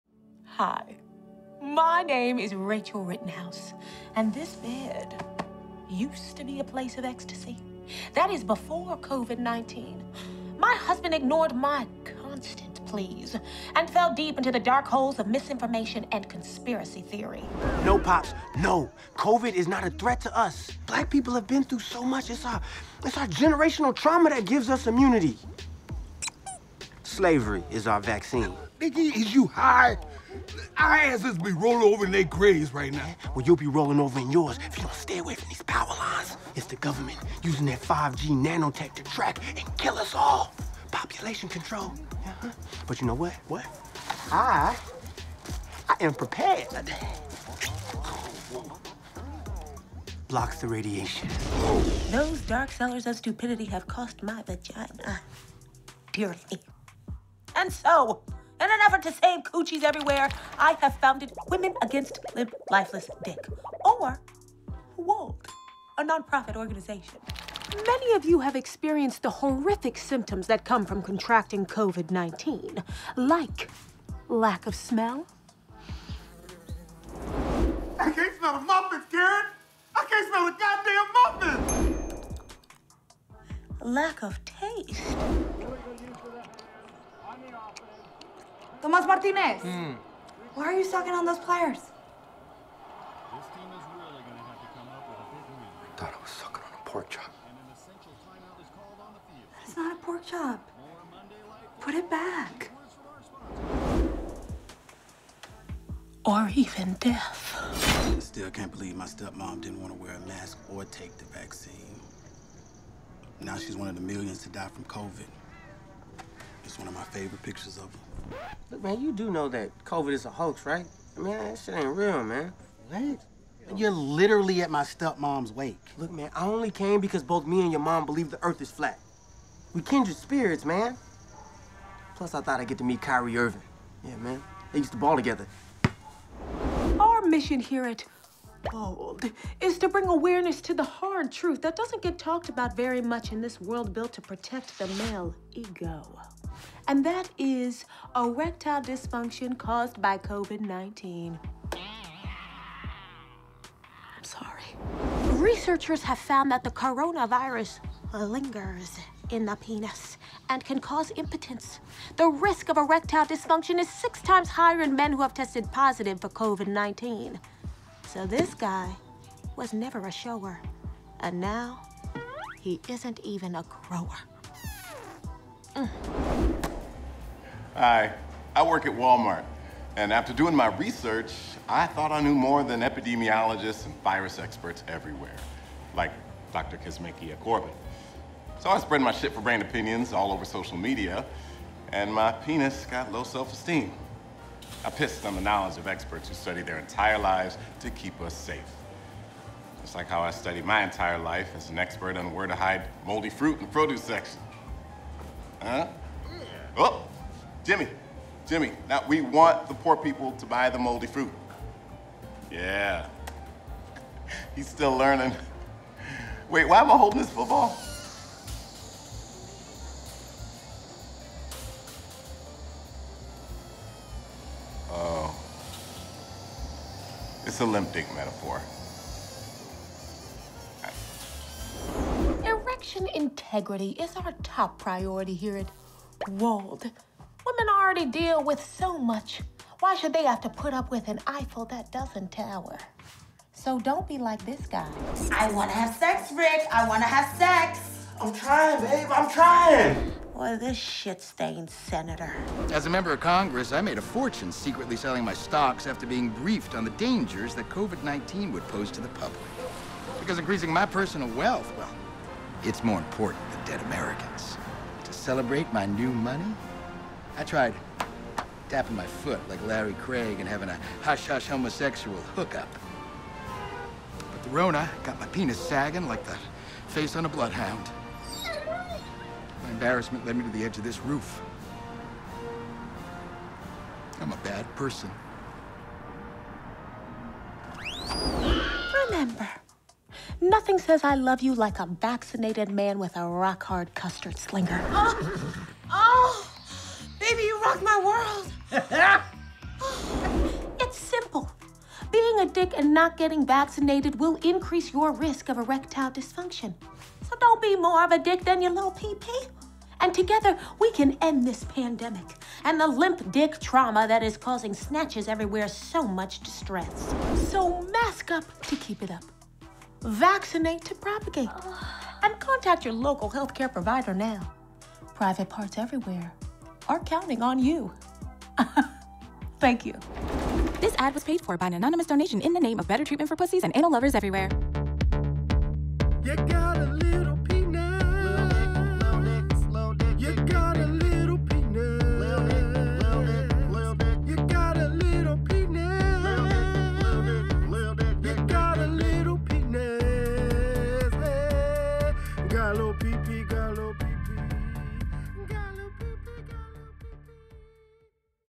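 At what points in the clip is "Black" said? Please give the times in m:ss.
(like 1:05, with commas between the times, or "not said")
0:20.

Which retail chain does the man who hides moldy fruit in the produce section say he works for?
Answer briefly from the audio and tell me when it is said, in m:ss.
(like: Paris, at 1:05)
Walmart, at 2:58.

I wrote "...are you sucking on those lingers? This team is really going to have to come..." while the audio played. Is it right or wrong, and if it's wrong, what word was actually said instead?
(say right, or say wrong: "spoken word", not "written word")
wrong: "players", not "lingers".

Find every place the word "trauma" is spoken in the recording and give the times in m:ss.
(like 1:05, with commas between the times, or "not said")
0:23, 5:13.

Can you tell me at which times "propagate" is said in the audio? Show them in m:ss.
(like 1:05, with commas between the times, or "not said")
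5:20.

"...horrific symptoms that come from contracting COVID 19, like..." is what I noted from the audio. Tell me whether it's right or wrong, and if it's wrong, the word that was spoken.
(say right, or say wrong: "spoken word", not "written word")
right.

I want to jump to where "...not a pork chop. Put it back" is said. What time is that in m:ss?
1:39.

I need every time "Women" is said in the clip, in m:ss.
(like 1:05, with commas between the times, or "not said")
1:01, 3:57.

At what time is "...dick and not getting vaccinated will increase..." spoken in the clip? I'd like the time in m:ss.
5:02.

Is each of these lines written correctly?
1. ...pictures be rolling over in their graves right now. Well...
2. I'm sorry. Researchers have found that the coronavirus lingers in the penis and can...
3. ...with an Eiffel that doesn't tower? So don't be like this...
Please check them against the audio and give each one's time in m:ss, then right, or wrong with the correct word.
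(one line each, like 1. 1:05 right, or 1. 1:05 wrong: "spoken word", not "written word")
1. 0:30 wrong: "asses", not "pictures"
2. 2:34 right
3. 4:00 right.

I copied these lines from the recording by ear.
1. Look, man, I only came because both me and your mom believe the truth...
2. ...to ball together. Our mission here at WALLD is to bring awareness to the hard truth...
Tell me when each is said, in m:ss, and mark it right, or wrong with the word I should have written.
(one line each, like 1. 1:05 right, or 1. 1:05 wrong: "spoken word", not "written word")
1. 2:05 wrong: "earth", not "truth"
2. 2:14 right.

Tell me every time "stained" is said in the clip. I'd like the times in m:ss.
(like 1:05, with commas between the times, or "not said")
4:10.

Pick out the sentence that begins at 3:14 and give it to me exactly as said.
I pissed on the knowledge of experts who study their entire lives to keep us safe.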